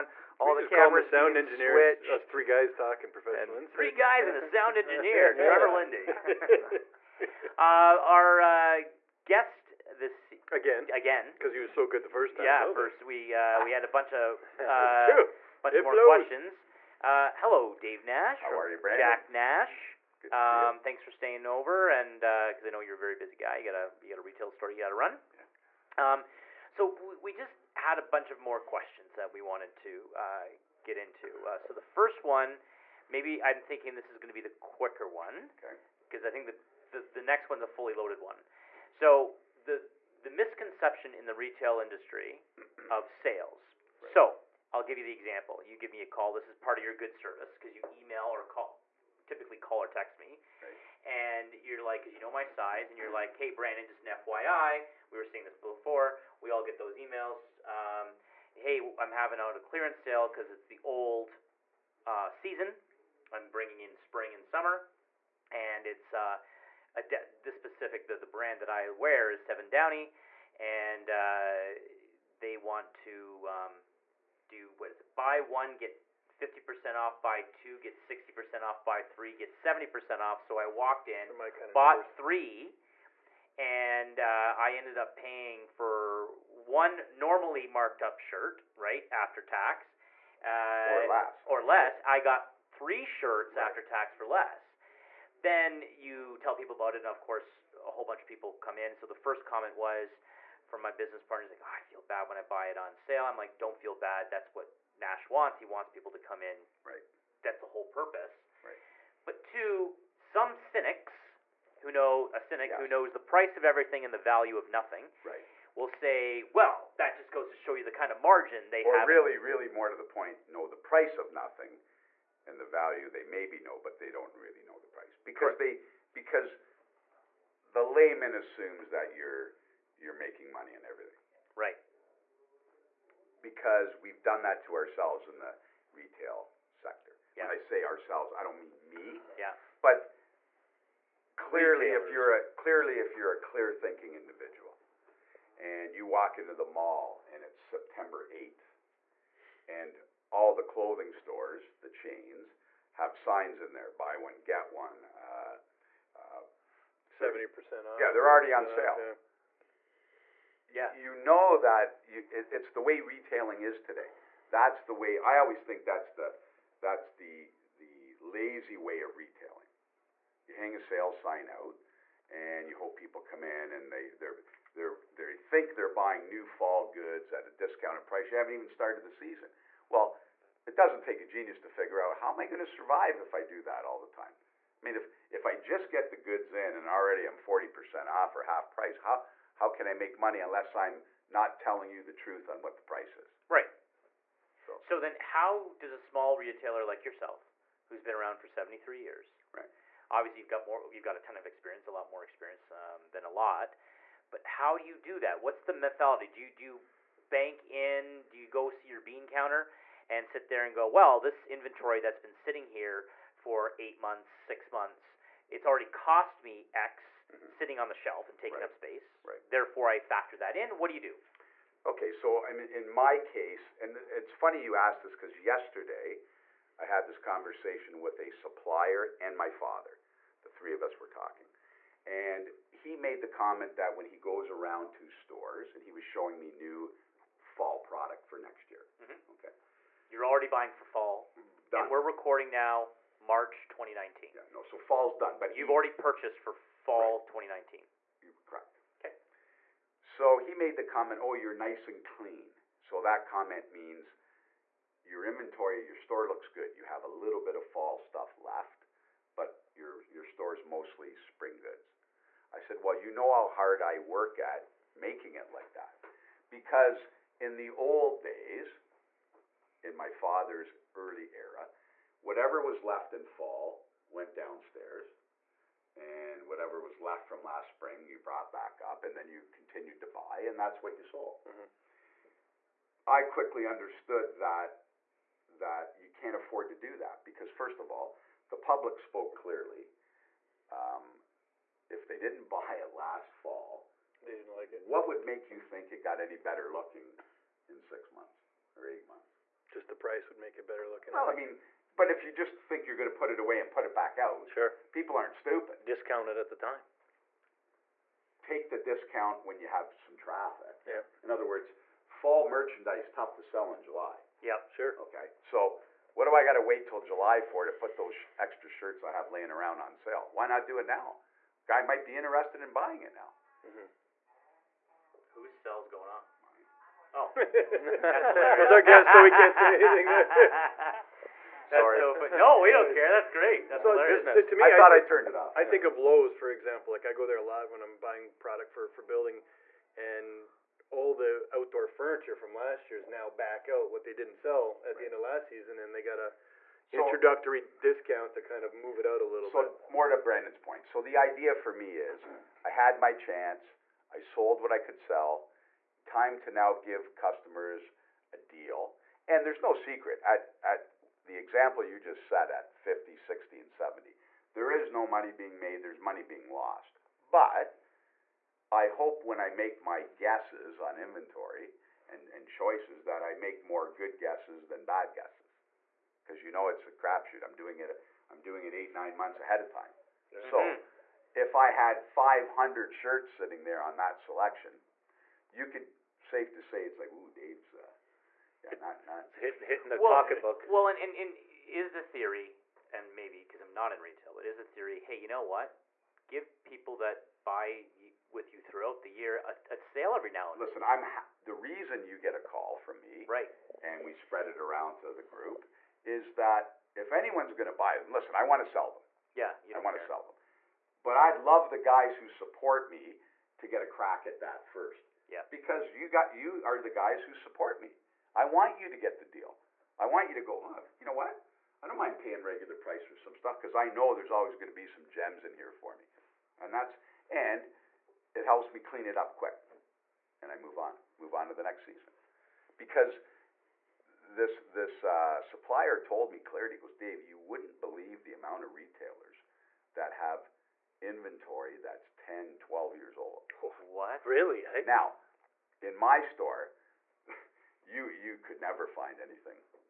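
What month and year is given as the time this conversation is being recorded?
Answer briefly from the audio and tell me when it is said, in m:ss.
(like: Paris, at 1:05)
March 2019, at 4:03.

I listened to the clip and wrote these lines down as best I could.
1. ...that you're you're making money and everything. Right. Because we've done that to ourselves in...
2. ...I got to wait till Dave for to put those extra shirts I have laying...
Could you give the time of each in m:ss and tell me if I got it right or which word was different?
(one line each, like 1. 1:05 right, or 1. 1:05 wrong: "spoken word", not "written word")
1. 2:08 right
2. 5:16 wrong: "July", not "Dave".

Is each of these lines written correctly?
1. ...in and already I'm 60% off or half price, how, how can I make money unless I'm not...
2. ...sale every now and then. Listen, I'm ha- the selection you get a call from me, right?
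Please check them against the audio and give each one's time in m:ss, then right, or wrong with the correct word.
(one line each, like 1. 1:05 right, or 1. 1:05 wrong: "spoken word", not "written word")
1. 3:06 wrong: "40", not "60"
2. 6:39 wrong: "reason", not "selection".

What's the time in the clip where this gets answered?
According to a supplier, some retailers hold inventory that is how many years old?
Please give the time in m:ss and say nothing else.
7:22.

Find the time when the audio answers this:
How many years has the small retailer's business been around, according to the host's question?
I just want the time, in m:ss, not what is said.
3:18.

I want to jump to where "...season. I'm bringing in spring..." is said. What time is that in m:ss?
1:02.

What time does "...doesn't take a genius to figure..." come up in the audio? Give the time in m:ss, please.
3:00.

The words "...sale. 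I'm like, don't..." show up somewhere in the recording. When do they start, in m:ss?
1:42.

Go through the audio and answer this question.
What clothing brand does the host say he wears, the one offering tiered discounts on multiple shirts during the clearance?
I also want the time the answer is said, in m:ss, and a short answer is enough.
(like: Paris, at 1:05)
Seven Downie, at 1:09.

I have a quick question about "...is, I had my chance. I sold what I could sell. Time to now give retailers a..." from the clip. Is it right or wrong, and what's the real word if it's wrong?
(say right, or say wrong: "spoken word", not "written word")
wrong: "customers", not "retailers".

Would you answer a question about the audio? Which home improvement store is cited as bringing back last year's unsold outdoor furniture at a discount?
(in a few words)
Lowe's.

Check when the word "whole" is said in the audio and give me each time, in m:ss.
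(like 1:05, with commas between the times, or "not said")
1:37, 1:47.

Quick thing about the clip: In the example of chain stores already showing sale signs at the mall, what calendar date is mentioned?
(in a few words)
September 8th.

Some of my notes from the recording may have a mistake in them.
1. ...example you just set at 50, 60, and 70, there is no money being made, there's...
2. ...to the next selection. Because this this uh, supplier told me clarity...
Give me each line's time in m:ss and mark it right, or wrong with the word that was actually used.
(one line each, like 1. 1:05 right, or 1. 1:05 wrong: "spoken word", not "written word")
1. 6:01 right
2. 7:11 wrong: "season", not "selection".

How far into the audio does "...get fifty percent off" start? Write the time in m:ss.
1:15.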